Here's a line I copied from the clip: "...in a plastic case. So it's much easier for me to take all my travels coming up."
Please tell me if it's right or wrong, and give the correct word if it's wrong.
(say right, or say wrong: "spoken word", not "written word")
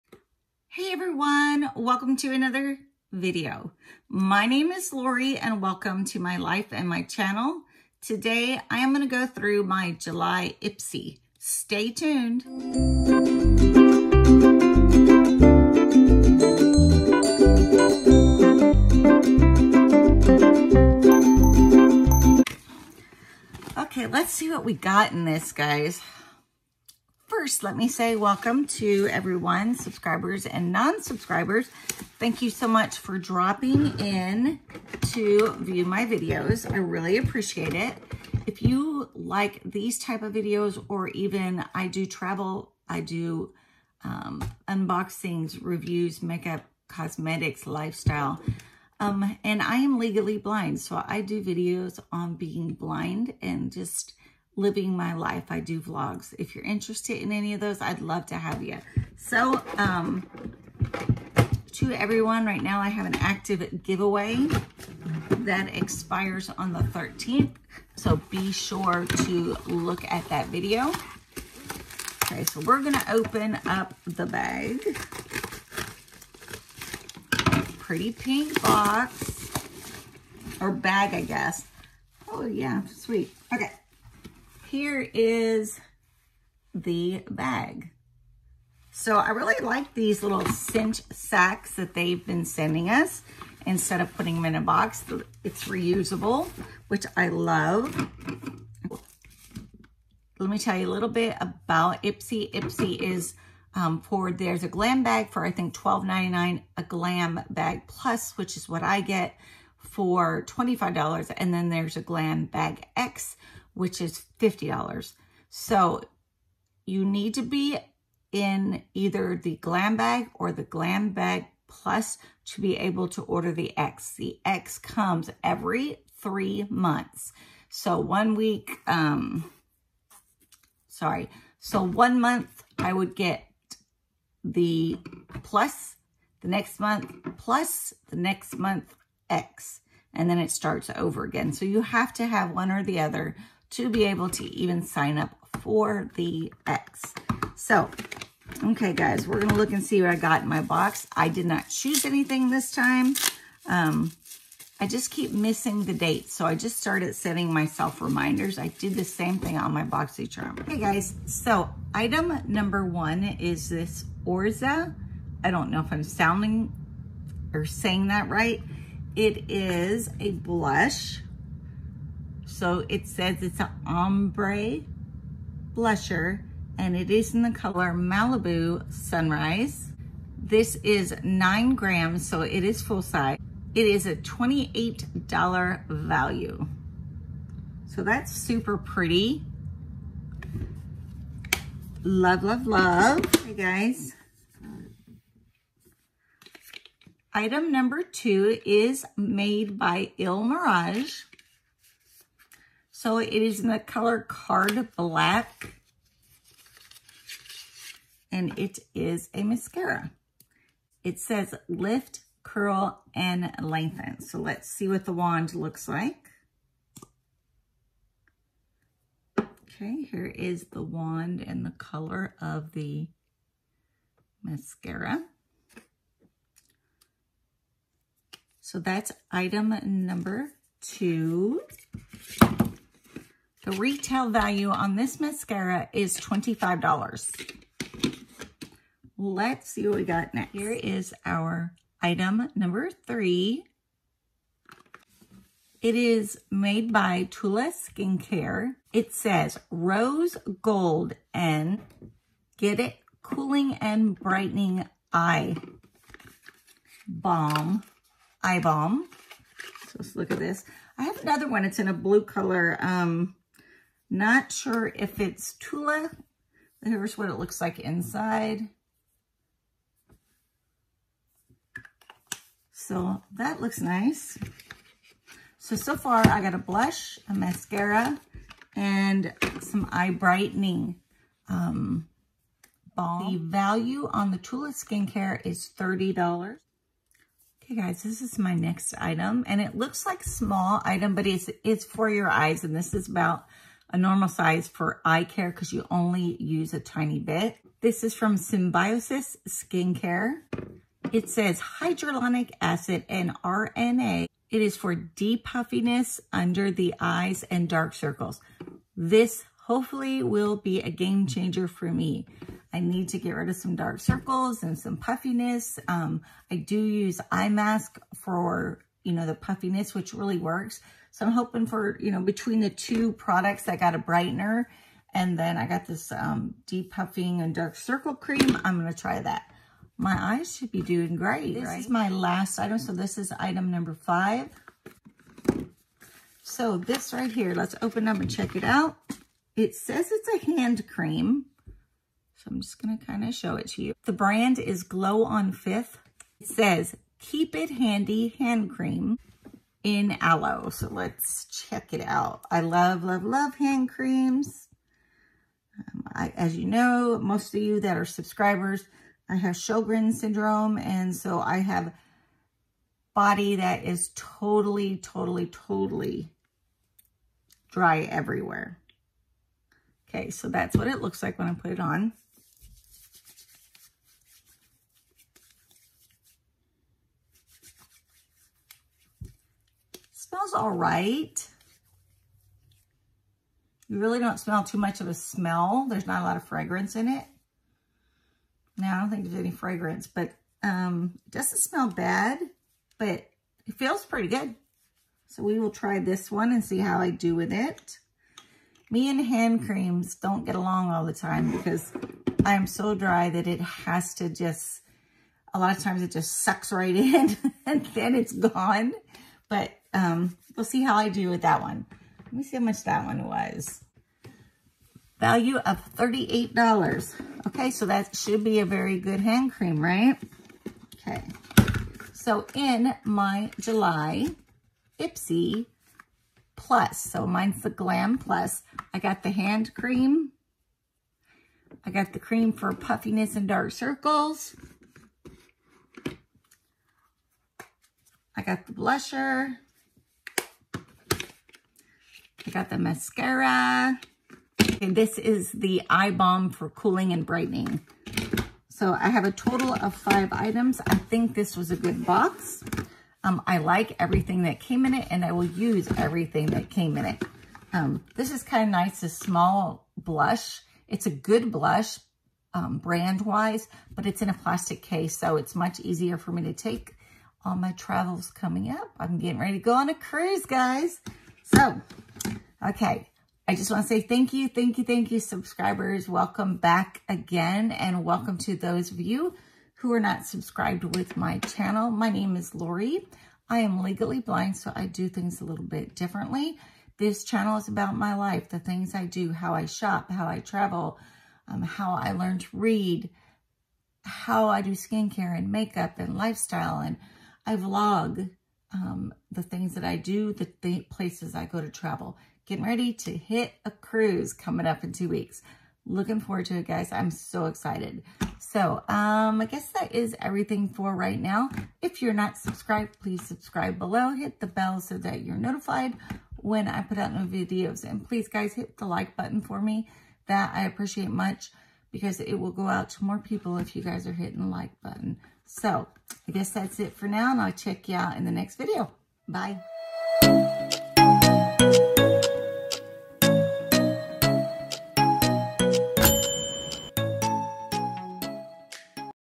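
right.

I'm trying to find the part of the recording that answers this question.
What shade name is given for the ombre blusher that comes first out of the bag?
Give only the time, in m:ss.
2:57.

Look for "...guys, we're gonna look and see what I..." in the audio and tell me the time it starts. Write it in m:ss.
2:28.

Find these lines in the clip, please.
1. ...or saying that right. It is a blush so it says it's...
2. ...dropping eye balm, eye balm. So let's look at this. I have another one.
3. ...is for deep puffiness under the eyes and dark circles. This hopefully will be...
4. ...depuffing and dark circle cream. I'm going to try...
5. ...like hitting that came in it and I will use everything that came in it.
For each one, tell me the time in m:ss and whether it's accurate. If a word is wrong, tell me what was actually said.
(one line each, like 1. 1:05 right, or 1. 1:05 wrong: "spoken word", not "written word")
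1. 2:47 right
2. 4:14 wrong: "brightening", not "dropping"
3. 5:04 right
4. 5:26 right
5. 7:33 wrong: "everything", not "hitting".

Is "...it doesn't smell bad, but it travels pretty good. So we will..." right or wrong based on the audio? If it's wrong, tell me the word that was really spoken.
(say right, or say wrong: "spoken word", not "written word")
wrong: "feels", not "travels".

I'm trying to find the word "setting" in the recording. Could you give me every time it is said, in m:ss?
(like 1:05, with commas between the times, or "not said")
2:37.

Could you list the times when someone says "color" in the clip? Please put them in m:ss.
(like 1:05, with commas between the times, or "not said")
2:57, 3:23, 3:41, 4:22.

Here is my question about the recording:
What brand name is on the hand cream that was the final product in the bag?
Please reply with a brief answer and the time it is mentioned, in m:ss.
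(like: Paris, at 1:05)
Glow on Fifth, at 5:44.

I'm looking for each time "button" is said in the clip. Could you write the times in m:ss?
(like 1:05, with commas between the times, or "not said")
8:39, 8:44.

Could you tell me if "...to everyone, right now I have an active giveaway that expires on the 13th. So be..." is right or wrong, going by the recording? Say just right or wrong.
right.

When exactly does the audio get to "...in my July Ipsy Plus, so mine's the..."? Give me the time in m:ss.
7:02.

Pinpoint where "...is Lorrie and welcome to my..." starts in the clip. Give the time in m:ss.
0:04.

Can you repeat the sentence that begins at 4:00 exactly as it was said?
Here is our item number three.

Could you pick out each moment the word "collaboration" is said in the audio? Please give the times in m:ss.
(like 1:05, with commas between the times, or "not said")
not said.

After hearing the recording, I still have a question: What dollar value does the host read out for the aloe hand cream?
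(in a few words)
$38.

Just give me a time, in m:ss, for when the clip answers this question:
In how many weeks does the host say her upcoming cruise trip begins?
8:24.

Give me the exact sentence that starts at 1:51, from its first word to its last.
And then there's a glam bag X, which is $50.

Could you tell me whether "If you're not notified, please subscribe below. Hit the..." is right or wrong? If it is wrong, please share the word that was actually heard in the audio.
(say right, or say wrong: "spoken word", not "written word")
wrong: "subscribed", not "notified".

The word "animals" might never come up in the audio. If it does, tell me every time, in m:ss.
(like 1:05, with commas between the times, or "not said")
not said.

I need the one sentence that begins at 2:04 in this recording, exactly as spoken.
The X comes every three months.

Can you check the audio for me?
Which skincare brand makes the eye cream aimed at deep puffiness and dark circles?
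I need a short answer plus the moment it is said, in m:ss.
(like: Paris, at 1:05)
Symbiosis Skincare, at 4:58.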